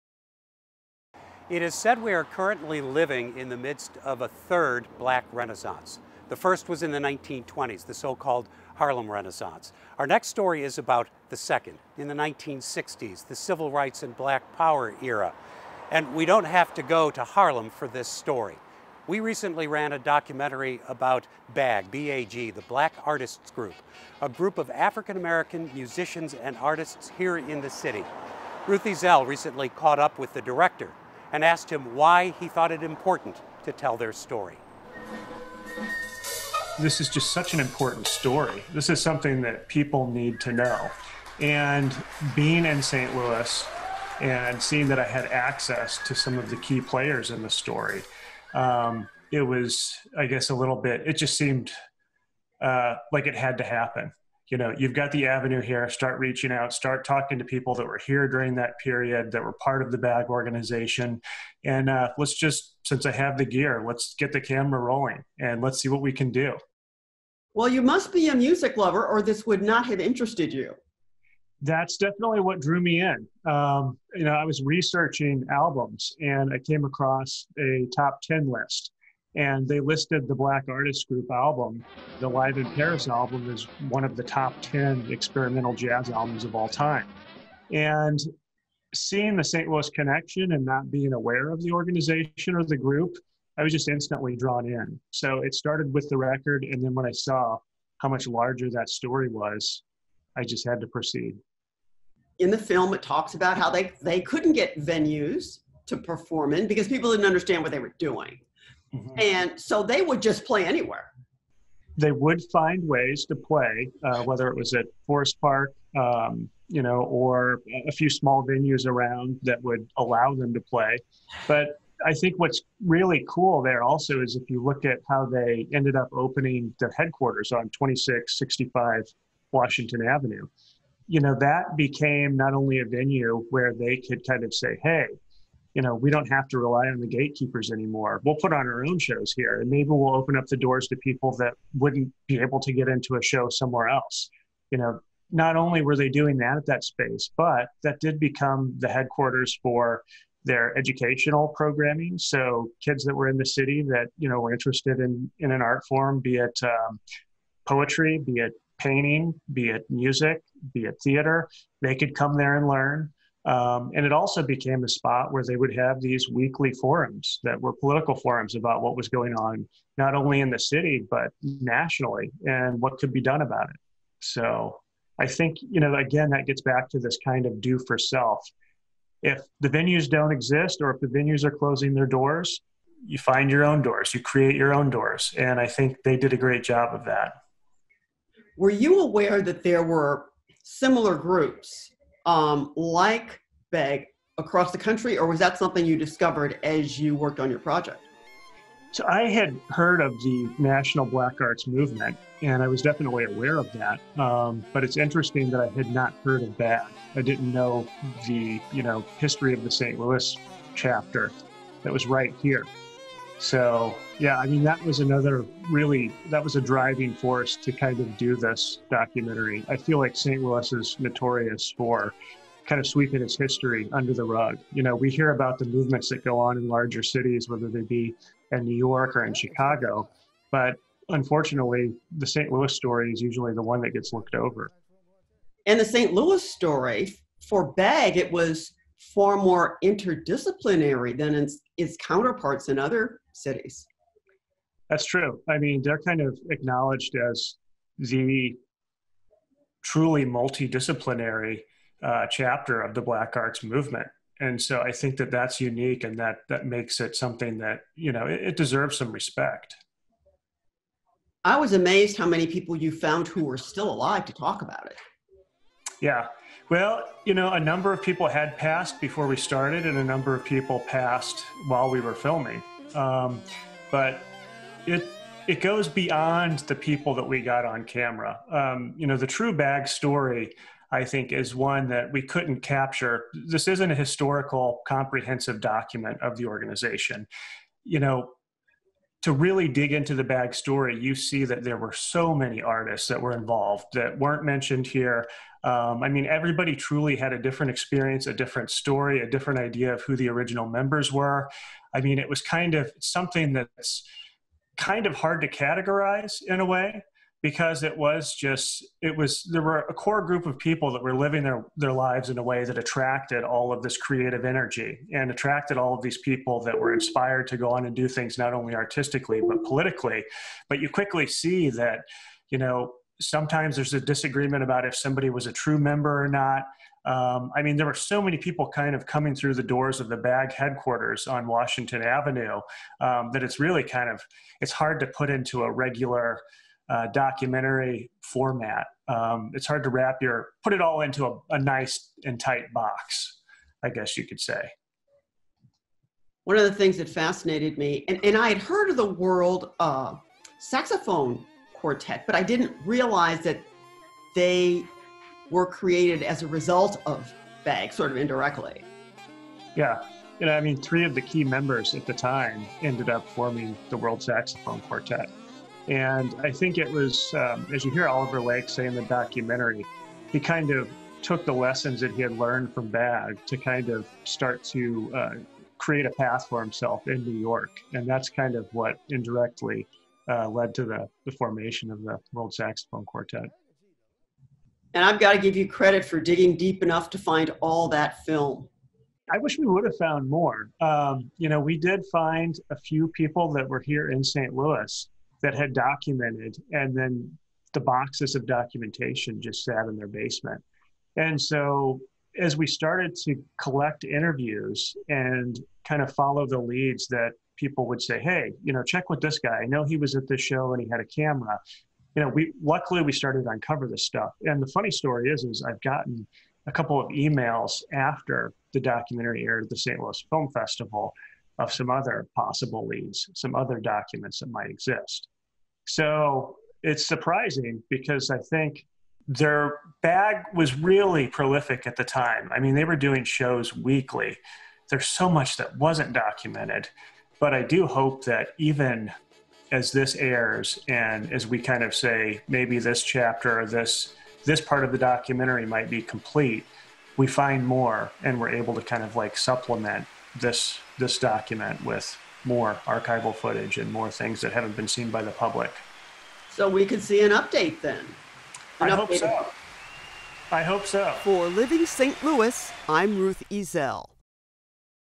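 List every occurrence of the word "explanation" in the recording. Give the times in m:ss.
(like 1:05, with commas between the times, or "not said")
not said.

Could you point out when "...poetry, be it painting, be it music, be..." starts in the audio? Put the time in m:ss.
2:37.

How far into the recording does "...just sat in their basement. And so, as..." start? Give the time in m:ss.
6:39.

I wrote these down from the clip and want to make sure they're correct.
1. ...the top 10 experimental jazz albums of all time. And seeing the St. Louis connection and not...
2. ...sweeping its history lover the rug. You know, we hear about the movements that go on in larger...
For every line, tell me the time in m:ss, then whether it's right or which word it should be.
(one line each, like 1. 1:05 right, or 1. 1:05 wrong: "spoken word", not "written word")
1. 1:24 right
2. 3:42 wrong: "under", not "lover".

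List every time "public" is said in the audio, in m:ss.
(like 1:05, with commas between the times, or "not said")
7:35.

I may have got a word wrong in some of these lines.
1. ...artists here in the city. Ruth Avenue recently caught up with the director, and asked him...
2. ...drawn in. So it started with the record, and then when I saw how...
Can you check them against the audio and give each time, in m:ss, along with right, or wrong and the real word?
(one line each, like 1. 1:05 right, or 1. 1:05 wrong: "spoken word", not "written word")
1. 0:26 wrong: "Ezell", not "Avenue"
2. 1:34 right.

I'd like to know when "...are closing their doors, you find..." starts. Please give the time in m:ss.
3:01.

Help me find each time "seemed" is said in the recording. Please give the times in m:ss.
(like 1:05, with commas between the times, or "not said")
0:51.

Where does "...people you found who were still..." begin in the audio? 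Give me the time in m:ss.
4:22.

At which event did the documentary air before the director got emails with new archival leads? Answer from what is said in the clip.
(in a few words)
St. Louis Film Festival.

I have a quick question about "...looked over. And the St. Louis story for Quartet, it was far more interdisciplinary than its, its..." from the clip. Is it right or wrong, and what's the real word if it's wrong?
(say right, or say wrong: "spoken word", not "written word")
wrong: "Bag", not "Quartet".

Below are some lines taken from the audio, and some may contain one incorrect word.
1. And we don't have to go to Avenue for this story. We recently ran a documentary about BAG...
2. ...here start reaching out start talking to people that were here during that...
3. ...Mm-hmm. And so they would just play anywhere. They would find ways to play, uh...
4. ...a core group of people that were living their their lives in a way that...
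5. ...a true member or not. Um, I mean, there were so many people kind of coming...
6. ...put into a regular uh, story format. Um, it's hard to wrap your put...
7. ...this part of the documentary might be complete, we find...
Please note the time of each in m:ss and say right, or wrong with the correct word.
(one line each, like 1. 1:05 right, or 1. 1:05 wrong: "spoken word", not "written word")
1. 0:15 wrong: "Harlem", not "Avenue"
2. 0:55 right
3. 1:48 right
4. 5:09 right
5. 5:25 right
6. 5:35 wrong: "documentary", not "story"
7. 7:24 right.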